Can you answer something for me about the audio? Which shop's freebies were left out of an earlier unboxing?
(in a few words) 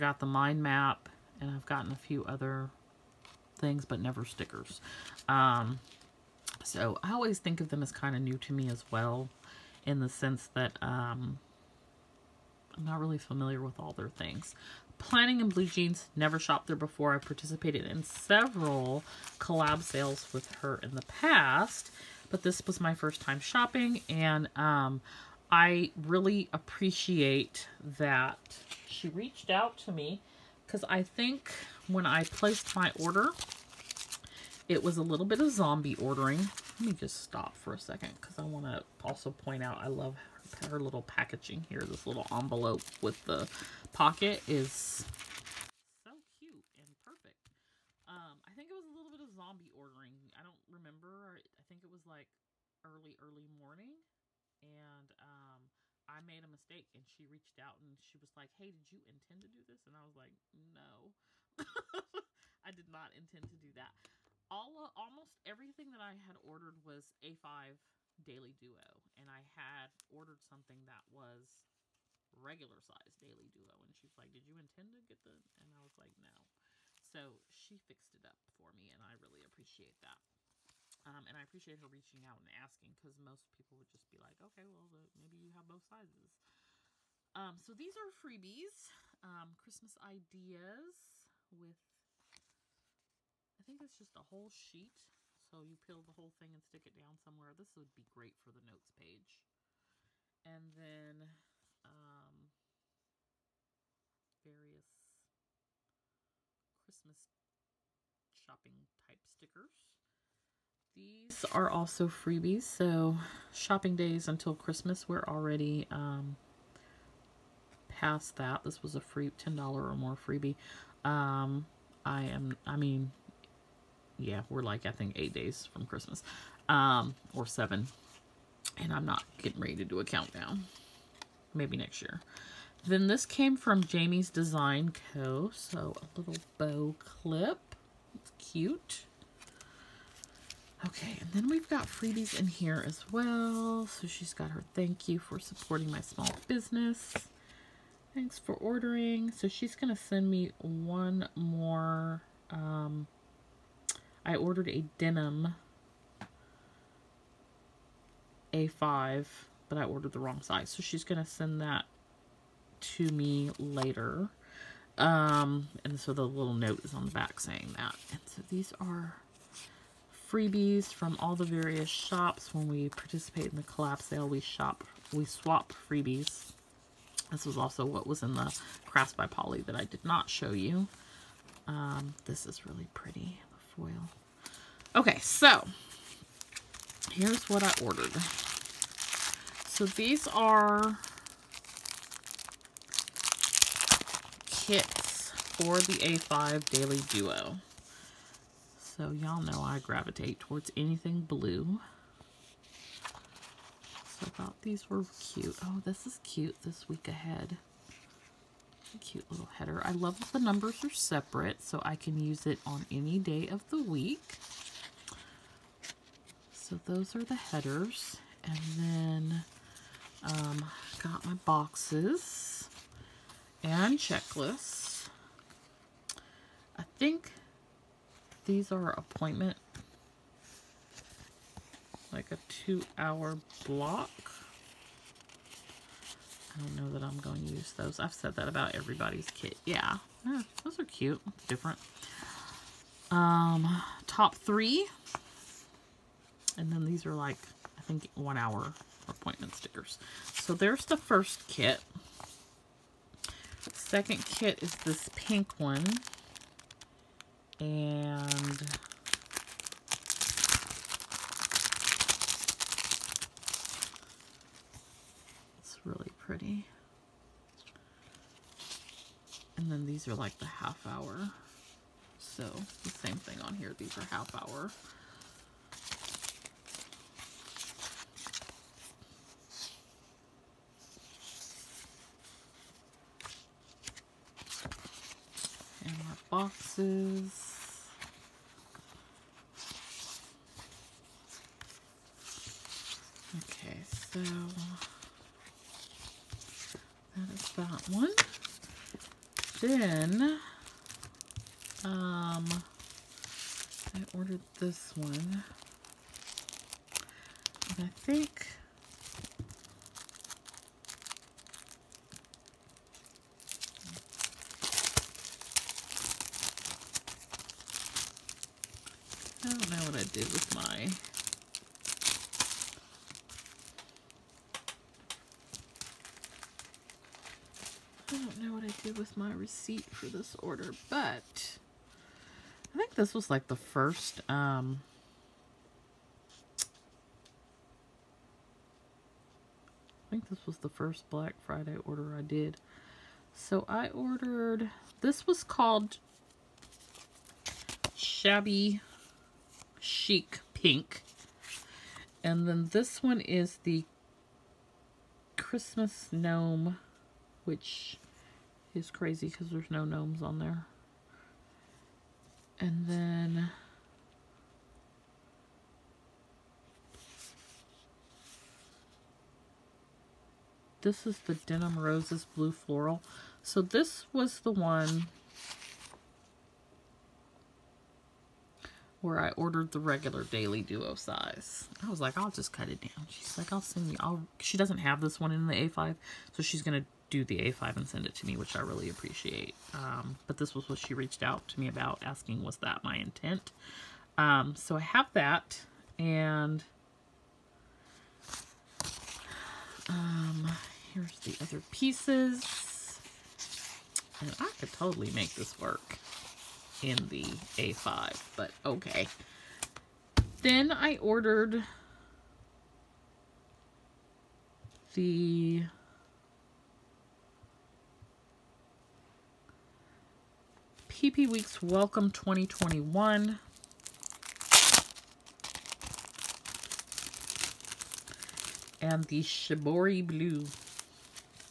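Crafts by Poli.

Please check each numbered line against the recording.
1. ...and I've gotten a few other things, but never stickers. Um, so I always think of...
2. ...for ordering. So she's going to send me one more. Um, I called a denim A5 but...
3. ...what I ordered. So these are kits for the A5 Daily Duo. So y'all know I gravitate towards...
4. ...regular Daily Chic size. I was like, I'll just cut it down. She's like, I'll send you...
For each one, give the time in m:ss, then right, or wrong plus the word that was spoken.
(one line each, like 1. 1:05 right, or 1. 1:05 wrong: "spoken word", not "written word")
1. 0:01 right
2. 2:28 wrong: "ordered", not "called"
3. 3:07 right
4. 6:19 wrong: "Duo", not "Chic".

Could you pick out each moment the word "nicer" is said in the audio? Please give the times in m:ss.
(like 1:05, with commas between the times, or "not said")
not said.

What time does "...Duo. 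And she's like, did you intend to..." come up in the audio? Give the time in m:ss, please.
1:13.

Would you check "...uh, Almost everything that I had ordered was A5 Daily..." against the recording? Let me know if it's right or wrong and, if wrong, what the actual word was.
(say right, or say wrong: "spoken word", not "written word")
right.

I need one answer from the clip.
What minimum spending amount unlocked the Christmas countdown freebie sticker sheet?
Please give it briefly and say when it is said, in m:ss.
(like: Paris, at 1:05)
$10, at 1:59.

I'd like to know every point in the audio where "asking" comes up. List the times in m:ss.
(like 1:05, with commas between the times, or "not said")
1:22, 6:32.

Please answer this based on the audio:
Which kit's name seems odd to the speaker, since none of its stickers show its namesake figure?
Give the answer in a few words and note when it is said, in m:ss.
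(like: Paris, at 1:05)
Christmas Gnome, at 5:55.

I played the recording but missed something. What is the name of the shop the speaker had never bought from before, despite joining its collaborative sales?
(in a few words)
Planning in Blue Jeans.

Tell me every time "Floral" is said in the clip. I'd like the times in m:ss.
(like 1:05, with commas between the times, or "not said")
6:12.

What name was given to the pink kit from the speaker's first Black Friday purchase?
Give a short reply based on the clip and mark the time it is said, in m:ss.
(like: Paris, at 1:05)
Shabby Chic Pink, at 5:47.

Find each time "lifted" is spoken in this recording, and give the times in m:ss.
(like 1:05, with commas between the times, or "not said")
not said.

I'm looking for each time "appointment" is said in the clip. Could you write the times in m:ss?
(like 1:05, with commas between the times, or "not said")
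3:48, 4:09.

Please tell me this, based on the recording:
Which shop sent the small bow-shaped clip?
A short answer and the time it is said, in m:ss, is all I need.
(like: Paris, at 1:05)
Jamie's Design Co, at 2:13.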